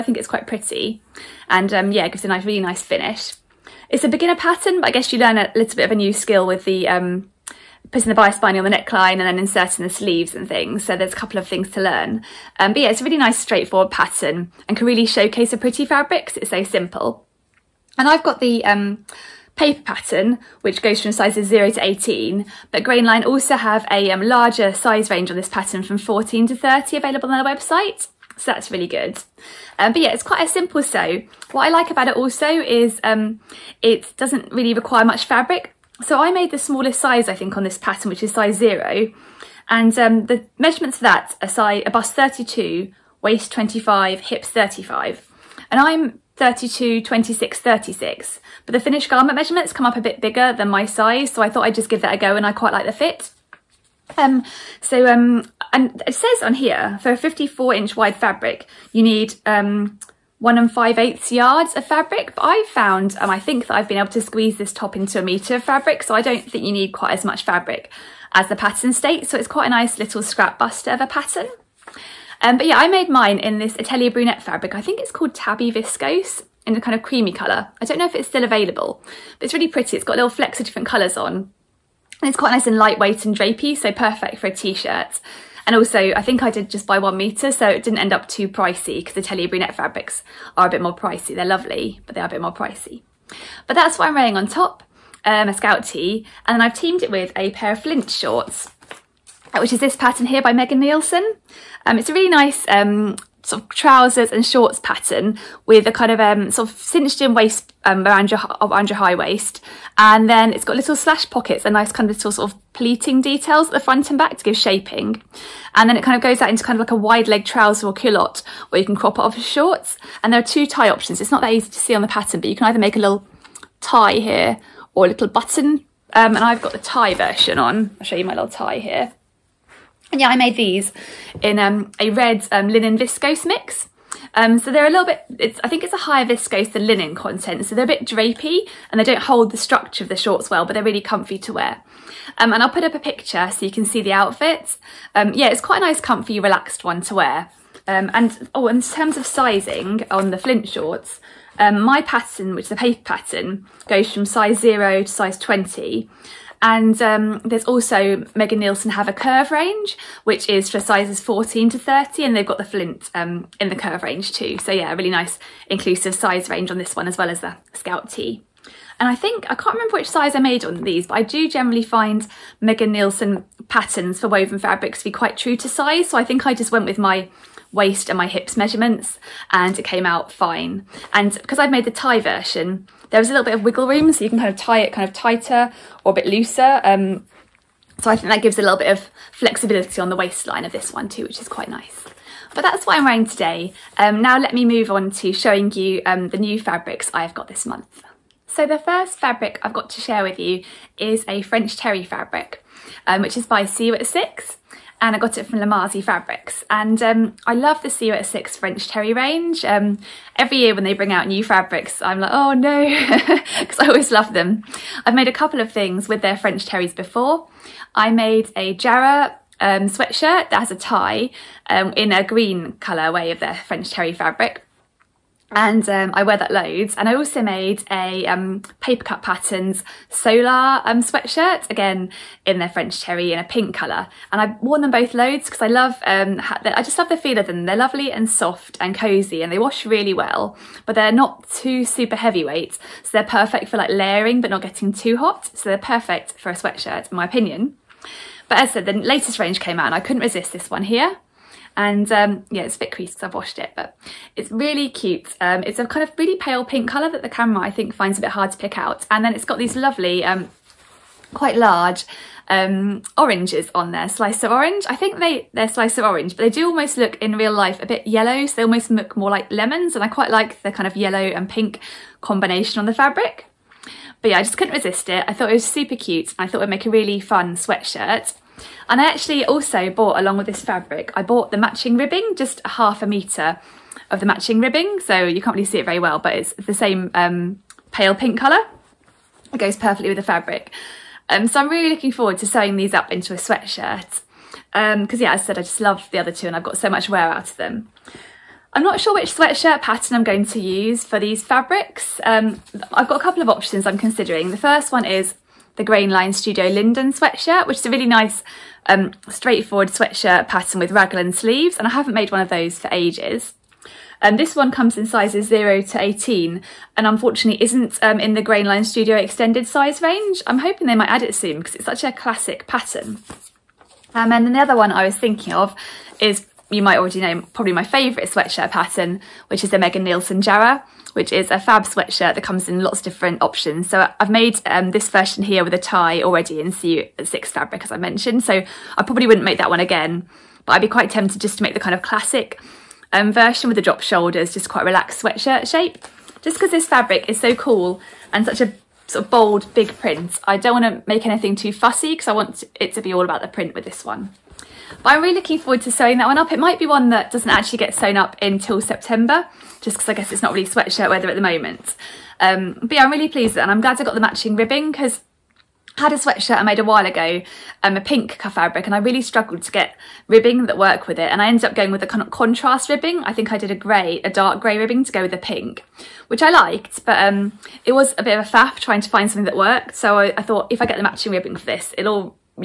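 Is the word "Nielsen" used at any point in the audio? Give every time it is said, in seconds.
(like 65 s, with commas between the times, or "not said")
100 s, 158 s, 172 s, 330 s.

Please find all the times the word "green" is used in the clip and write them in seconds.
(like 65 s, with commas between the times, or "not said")
222 s.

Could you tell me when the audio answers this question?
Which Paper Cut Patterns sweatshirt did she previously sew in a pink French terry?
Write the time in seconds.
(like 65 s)
230 s.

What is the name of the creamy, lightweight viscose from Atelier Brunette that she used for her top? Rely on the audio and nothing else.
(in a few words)
Tabby Viscose.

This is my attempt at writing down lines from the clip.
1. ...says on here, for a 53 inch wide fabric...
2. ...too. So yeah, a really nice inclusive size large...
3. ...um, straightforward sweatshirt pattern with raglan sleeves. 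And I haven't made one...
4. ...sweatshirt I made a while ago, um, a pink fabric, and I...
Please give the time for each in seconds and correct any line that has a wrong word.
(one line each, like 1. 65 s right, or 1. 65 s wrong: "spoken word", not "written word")
1. 56 s wrong: "54", not "53"
2. 164 s wrong: "range", not "large"
3. 308 s right
4. 366 s right.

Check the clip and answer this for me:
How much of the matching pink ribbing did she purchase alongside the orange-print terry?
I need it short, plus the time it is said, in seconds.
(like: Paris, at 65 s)
half a metre, at 282 s.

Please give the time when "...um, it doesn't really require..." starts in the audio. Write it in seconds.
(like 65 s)
33 s.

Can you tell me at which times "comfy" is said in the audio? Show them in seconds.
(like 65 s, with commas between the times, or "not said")
140 s, 145 s.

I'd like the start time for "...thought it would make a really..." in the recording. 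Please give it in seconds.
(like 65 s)
276 s.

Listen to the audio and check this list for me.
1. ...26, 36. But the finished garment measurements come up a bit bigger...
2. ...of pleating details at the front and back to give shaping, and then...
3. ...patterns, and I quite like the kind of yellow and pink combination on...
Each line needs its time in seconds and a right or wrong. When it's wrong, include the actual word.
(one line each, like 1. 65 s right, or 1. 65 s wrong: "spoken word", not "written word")
1. 47 s right
2. 112 s right
3. 269 s wrong: "lemons", not "patterns".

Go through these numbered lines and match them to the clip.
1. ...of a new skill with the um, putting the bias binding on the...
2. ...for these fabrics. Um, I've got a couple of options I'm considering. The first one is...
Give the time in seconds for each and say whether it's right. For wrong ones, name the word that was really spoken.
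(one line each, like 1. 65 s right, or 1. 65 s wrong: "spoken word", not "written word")
1. 5 s right
2. 301 s right.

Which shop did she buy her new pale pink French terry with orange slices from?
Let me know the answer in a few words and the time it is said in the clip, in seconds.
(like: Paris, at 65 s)
Lamazi Fabrics, at 205 s.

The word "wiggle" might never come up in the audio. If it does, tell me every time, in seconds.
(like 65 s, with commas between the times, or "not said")
183 s.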